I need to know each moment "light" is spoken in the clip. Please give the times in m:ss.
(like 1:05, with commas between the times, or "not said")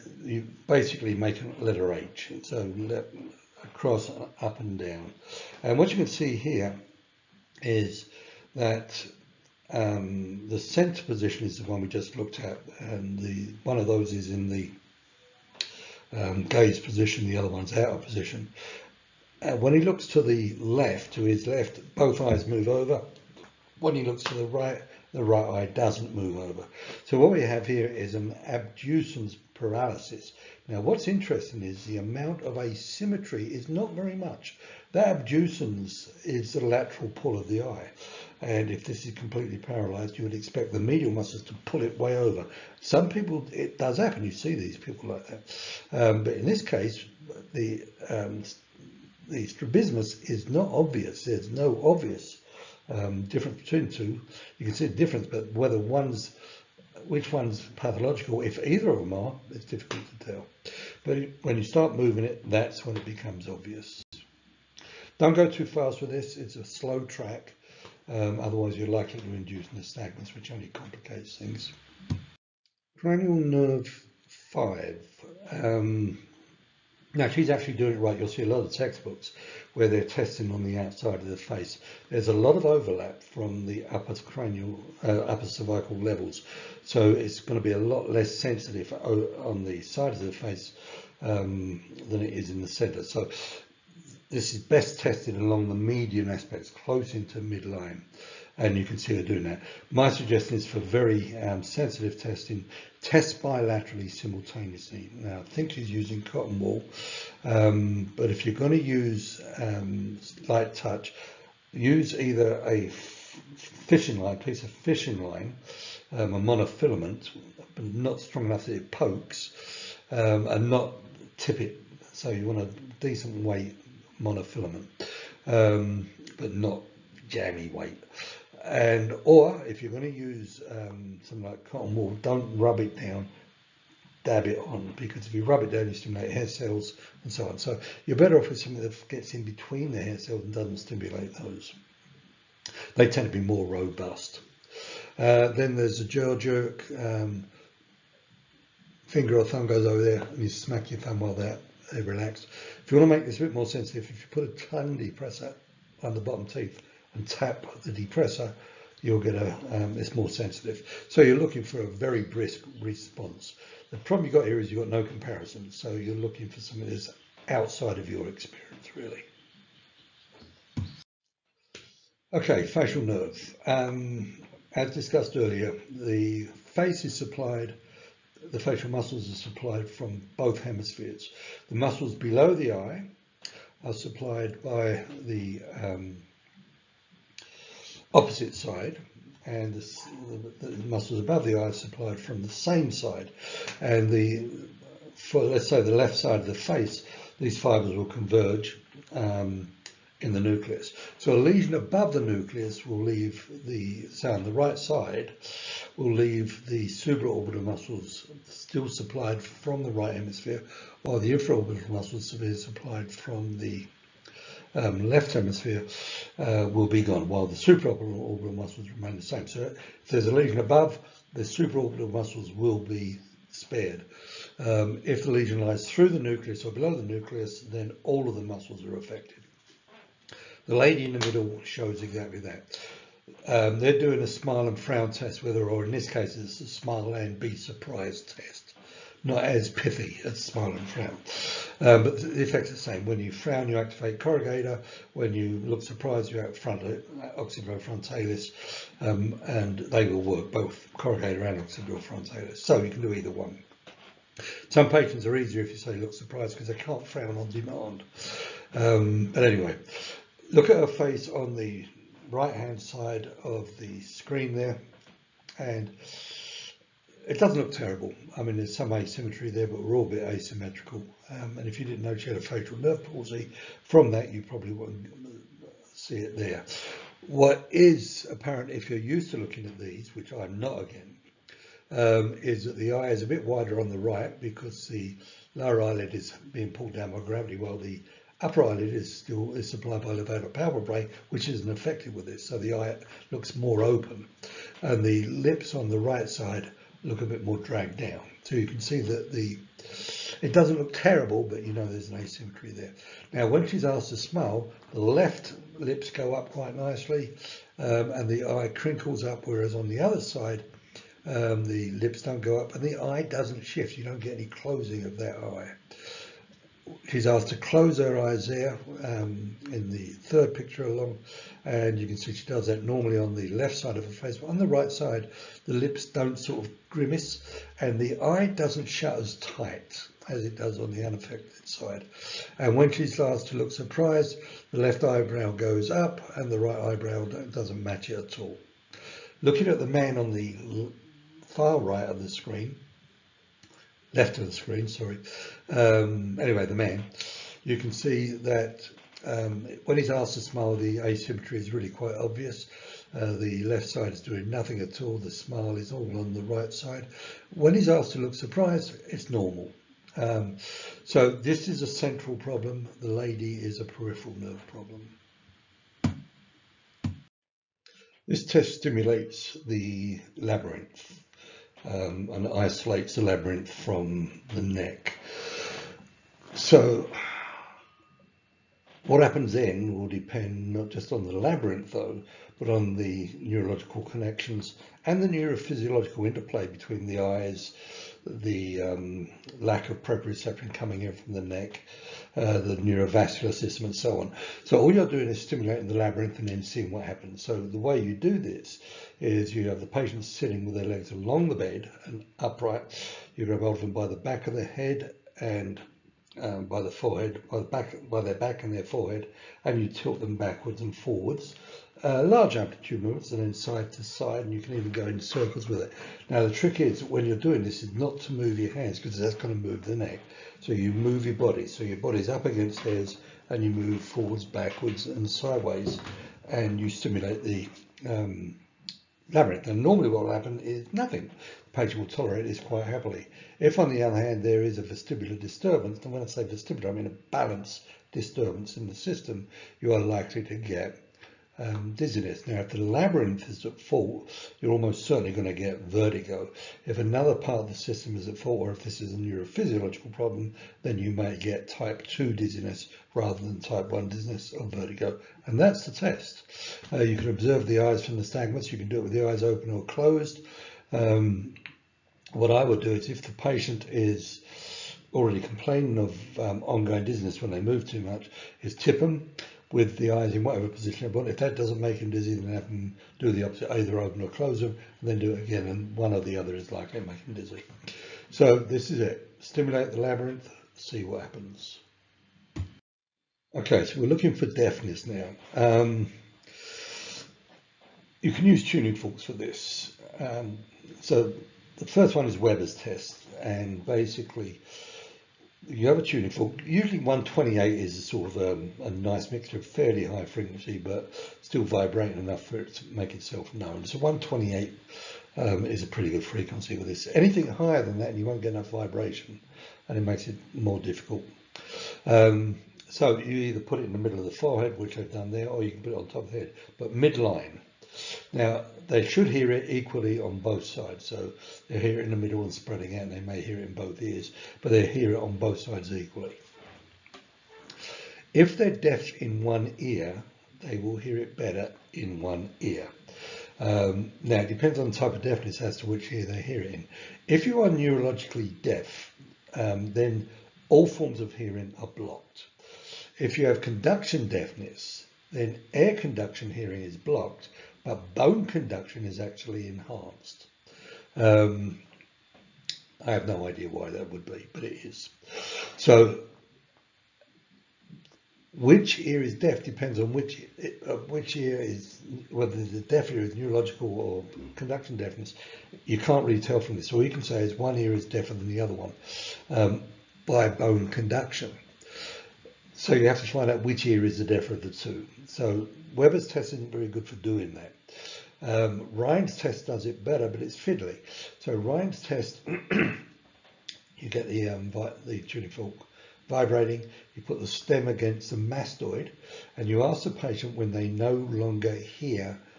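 1:50.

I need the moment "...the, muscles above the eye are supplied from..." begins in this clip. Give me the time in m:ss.
3:10.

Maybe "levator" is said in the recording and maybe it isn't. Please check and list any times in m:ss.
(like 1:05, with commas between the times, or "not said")
4:50.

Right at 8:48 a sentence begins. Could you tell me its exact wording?
If they're deaf in one ear, they will hear it better in one ear.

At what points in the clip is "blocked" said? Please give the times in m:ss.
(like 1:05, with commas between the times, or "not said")
9:01, 9:06.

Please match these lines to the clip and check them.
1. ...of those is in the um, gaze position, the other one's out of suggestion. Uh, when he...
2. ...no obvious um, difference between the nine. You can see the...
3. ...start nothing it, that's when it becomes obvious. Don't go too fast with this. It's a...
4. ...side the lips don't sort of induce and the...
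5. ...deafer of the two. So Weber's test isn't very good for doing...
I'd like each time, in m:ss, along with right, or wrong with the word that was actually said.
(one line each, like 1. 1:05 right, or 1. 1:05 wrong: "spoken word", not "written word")
1. 0:13 wrong: "position", not "suggestion"
2. 0:51 wrong: "two", not "nine"
3. 1:01 wrong: "moving", not "nothing"
4. 5:24 wrong: "grimace", not "induce"
5. 9:34 right.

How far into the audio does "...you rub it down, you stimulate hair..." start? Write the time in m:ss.
2:15.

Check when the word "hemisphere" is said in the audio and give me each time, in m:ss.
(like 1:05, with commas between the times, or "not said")
3:00, 3:30, 3:35.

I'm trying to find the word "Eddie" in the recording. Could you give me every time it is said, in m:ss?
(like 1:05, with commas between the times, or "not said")
not said.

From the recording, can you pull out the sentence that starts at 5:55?
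The smile is all on the right side.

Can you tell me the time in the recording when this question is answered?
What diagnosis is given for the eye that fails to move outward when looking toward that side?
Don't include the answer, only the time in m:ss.
0:28.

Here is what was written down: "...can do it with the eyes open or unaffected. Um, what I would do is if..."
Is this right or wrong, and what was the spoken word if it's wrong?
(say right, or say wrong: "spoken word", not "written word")
wrong: "closed", not "unaffected".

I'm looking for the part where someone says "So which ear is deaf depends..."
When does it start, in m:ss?
9:15.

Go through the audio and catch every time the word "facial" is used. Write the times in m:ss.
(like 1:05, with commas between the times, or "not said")
2:52, 2:58, 4:32.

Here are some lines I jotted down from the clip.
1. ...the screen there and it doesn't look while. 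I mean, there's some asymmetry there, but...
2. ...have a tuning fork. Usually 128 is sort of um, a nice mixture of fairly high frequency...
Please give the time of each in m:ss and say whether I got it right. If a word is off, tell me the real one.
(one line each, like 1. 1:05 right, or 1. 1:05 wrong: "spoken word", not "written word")
1. 4:23 wrong: "terrible", not "while"
2. 8:15 right.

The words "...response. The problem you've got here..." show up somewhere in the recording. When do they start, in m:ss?
2:42.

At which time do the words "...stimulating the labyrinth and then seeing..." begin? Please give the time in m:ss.
6:35.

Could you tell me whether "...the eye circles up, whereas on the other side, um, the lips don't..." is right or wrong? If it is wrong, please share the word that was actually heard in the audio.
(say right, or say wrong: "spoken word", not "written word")
wrong: "crinkles", not "circles".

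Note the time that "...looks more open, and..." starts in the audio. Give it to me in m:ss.
4:53.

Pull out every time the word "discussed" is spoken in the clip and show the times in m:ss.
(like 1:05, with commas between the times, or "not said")
2:54.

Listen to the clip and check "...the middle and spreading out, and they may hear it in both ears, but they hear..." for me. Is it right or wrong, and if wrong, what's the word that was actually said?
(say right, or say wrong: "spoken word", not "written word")
right.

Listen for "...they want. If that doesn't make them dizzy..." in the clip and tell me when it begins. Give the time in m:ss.
7:51.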